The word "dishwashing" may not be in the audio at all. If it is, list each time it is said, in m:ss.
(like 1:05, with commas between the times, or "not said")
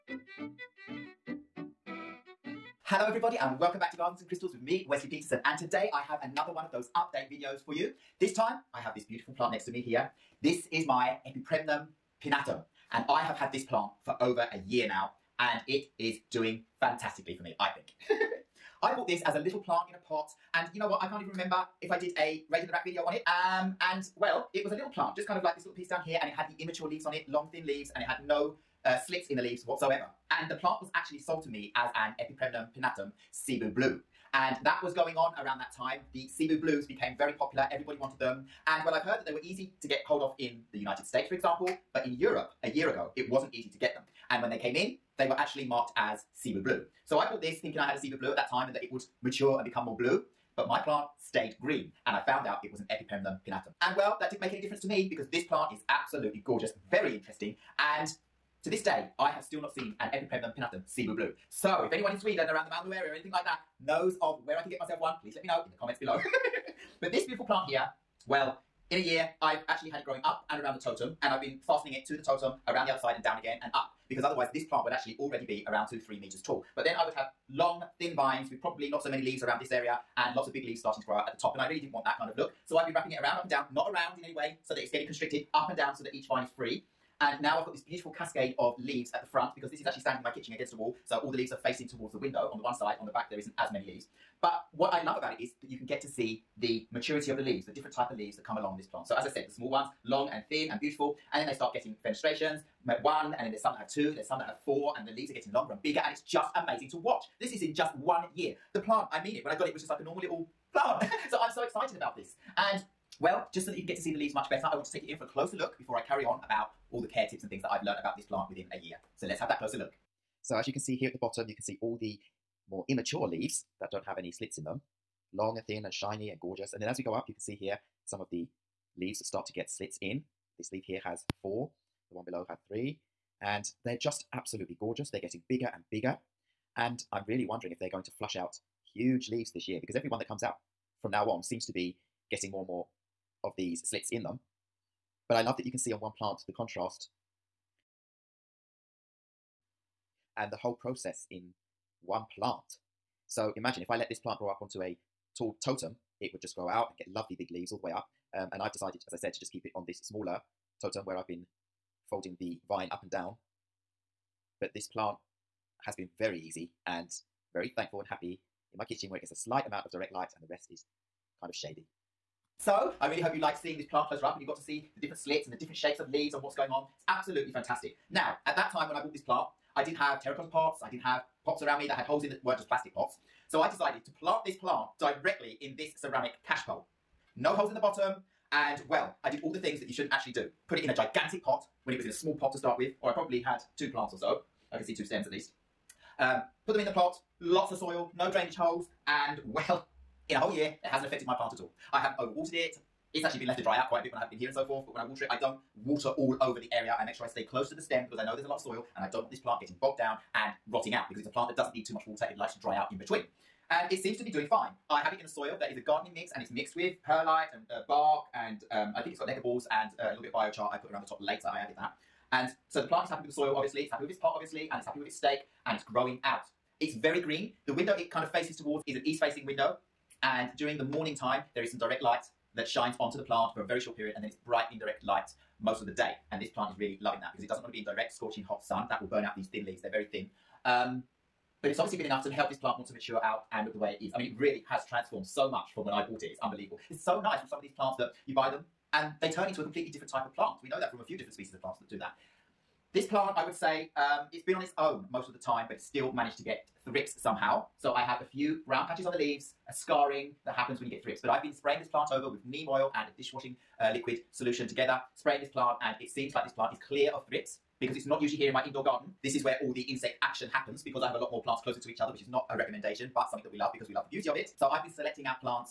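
4:23.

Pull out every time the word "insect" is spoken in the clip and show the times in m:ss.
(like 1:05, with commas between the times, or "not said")
4:29.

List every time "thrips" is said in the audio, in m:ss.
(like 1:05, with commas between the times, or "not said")
4:16, 4:21, 4:27.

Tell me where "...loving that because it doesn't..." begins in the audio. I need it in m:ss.
3:57.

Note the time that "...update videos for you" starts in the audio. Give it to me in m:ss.
0:06.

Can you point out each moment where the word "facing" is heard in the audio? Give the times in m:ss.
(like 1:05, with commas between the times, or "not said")
1:31, 3:49.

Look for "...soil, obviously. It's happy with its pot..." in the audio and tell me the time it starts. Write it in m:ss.
3:43.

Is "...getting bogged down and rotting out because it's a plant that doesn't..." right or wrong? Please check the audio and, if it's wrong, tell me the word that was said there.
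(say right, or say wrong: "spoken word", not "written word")
right.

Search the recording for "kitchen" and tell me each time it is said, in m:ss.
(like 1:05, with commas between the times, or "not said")
1:30, 2:48.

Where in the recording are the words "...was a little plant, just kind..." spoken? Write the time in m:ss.
0:24.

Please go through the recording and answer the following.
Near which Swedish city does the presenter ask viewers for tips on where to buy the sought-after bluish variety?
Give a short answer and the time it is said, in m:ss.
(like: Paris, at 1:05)
Malmö, at 1:02.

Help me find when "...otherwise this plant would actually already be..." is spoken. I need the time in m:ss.
1:14.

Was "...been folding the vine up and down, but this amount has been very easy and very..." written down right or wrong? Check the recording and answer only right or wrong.
wrong.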